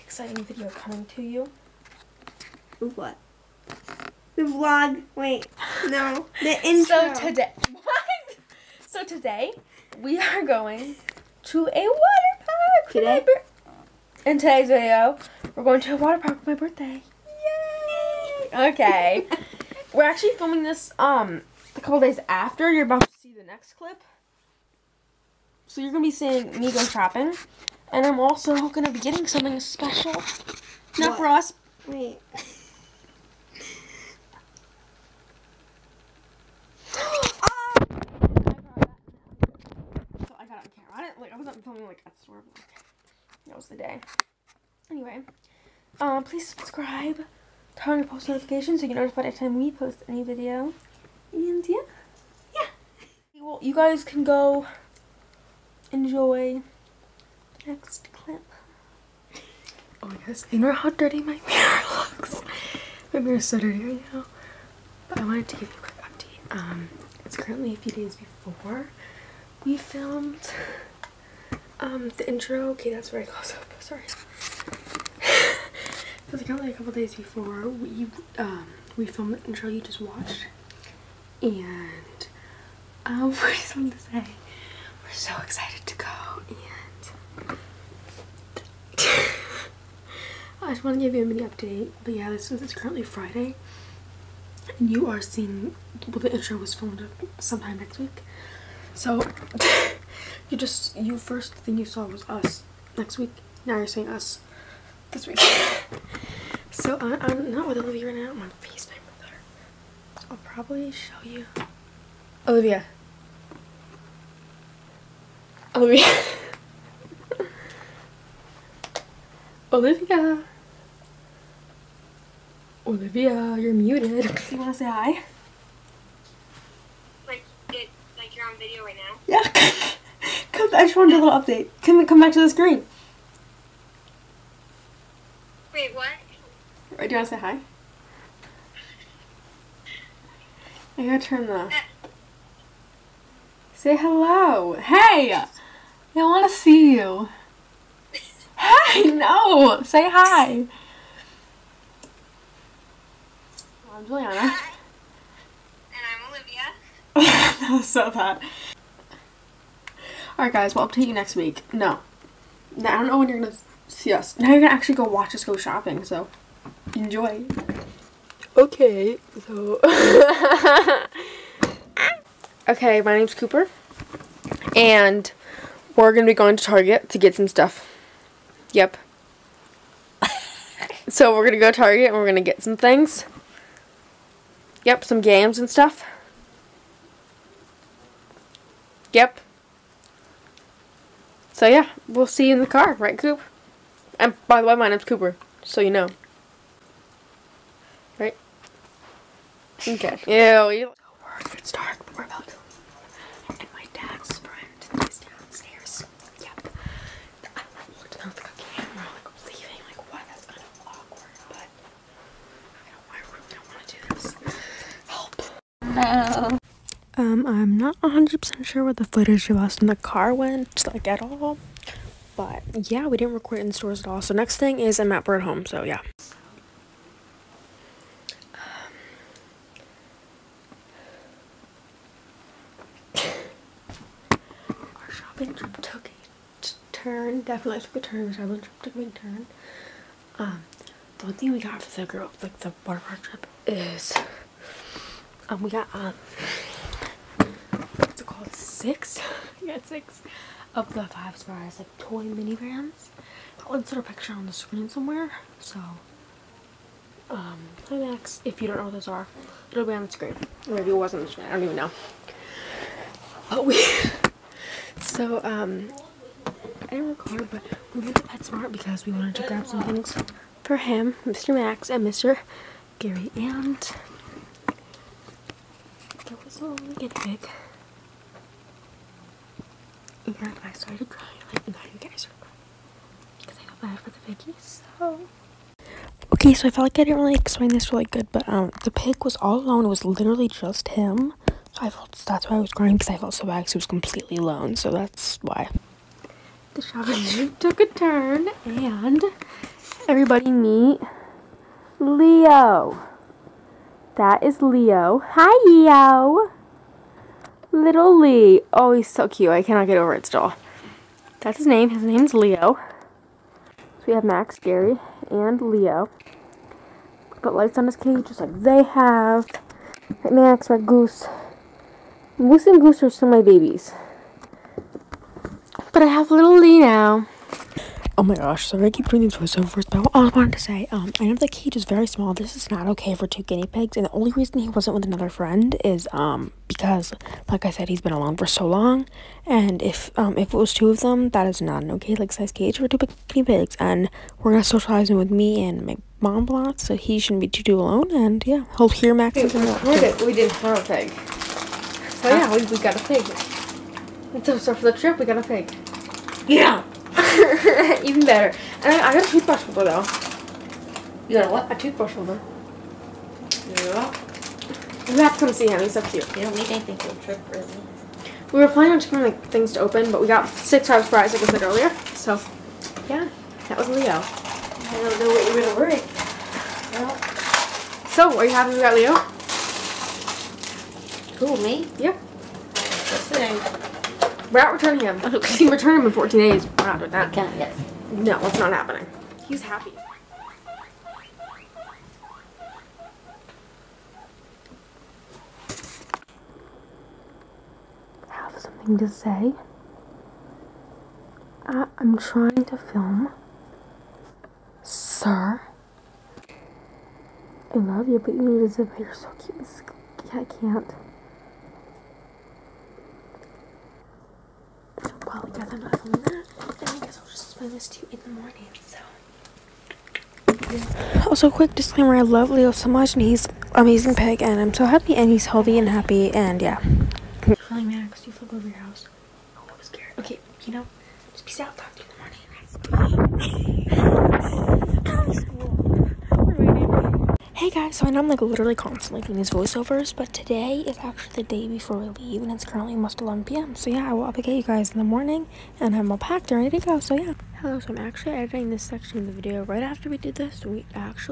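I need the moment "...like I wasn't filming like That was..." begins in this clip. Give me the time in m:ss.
0:41.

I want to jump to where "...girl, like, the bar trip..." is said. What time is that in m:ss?
4:02.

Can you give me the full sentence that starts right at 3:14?
And by the way, my name's Cooper, so you know.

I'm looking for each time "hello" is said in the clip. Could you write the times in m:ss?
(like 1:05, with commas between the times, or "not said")
2:23, 7:27.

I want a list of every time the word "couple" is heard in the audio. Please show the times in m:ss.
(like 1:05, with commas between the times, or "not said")
0:21, 1:16.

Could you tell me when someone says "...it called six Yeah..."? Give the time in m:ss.
4:08.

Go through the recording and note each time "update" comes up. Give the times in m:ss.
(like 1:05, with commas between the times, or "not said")
1:06, 1:31, 2:11, 2:40, 7:24.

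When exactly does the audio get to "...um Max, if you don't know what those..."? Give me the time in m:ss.
4:17.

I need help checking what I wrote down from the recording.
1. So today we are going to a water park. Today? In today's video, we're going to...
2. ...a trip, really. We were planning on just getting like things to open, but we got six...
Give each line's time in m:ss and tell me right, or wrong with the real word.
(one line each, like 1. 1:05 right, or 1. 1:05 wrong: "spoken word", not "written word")
1. 0:08 right
2. 6:07 right.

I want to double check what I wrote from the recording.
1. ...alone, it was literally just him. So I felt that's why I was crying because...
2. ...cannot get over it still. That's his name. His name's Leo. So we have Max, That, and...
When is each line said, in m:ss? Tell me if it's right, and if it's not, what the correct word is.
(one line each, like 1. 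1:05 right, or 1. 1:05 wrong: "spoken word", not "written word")
1. 4:49 right
2. 5:09 wrong: "Gary", not "That".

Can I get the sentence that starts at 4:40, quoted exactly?
And I started crying, like now you guys are crying.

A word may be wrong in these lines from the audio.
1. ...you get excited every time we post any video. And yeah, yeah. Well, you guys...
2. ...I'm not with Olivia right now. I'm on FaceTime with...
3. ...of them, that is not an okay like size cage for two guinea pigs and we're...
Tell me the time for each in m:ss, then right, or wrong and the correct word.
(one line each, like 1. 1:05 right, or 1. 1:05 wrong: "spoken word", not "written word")
1. 0:48 wrong: "notified", not "excited"
2. 1:47 right
3. 5:40 right.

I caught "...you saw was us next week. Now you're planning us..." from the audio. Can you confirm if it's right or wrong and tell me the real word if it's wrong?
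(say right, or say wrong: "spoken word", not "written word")
wrong: "seeing", not "planning".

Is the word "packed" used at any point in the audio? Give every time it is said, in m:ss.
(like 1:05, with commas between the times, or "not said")
7:26.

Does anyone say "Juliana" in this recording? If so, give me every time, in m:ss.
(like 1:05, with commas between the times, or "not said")
2:34.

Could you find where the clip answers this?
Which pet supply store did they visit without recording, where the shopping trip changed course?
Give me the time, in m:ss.
4:28.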